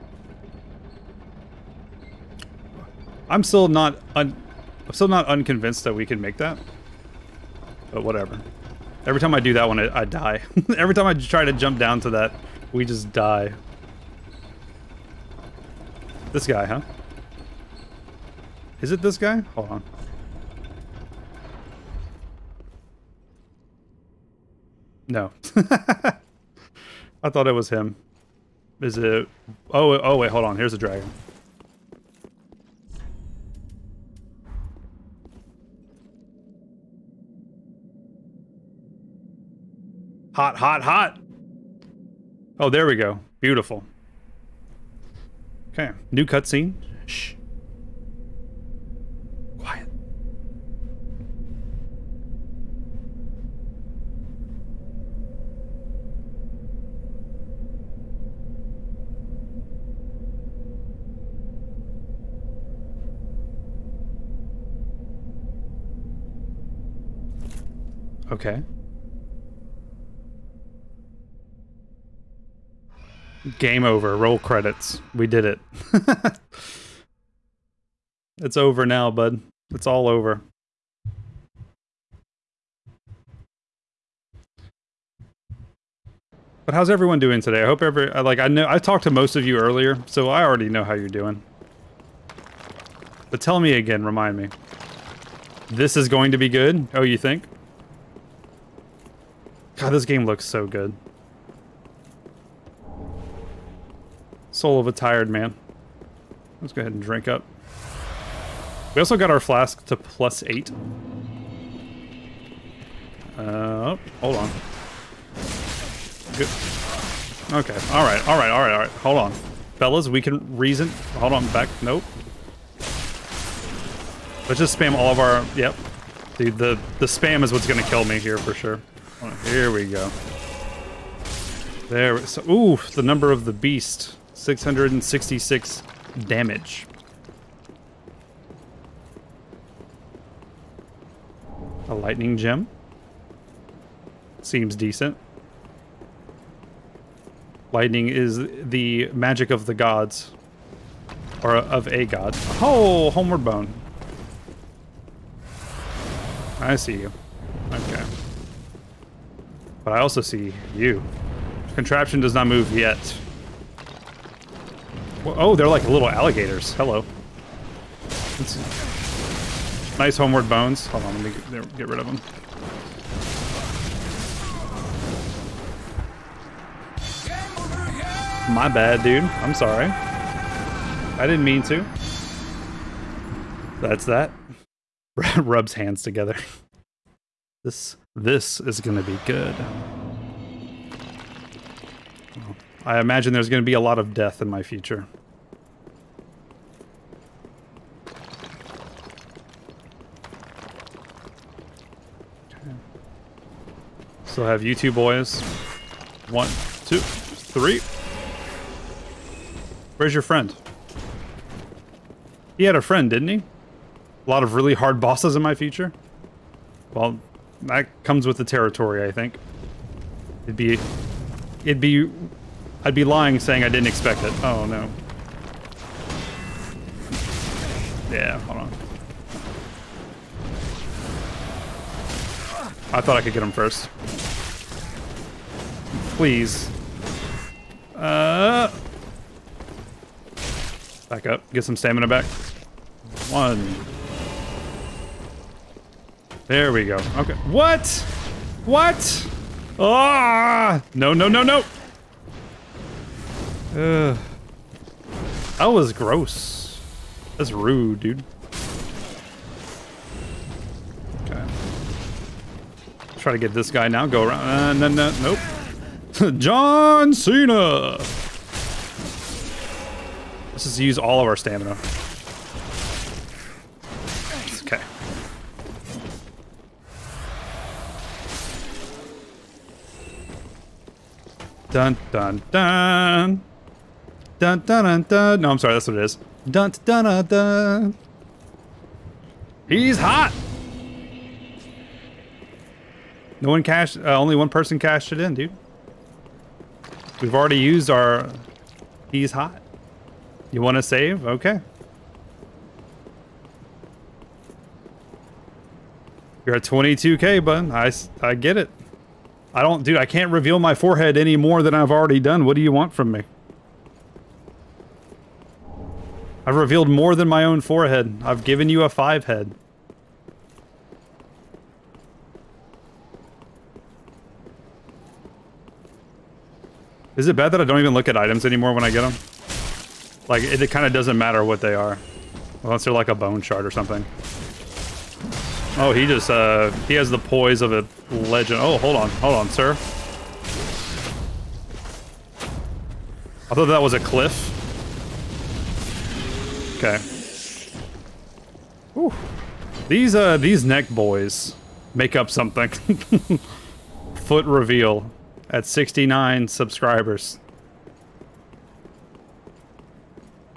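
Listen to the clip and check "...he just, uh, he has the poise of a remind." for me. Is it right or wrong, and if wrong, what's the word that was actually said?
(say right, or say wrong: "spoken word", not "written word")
wrong: "legend", not "remind".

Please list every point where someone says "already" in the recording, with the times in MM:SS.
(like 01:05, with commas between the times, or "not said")
01:30, 04:57, 05:11.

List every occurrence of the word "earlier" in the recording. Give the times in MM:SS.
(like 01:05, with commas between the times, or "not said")
01:29.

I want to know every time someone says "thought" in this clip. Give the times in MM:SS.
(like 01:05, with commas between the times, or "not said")
00:27, 03:53, 05:43.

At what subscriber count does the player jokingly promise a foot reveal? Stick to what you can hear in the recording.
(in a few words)
69.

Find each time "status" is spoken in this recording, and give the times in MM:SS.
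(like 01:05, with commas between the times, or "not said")
not said.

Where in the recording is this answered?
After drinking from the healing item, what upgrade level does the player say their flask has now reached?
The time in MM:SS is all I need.
01:49.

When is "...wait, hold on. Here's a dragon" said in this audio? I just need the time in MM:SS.
00:30.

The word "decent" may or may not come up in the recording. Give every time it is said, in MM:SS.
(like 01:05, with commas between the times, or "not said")
02:24.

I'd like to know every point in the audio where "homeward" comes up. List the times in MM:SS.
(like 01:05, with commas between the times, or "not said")
02:33, 02:50.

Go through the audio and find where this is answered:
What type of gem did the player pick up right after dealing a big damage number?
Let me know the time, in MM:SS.
02:21.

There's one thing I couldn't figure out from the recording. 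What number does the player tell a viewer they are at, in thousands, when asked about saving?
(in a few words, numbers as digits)
22k.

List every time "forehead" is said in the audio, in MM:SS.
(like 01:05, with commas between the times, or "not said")
05:10, 05:17.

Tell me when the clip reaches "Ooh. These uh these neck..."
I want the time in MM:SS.
05:48.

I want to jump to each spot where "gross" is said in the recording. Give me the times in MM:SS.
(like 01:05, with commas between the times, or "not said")
04:15.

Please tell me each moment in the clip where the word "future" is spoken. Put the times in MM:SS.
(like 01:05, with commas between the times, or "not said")
03:14, 03:35.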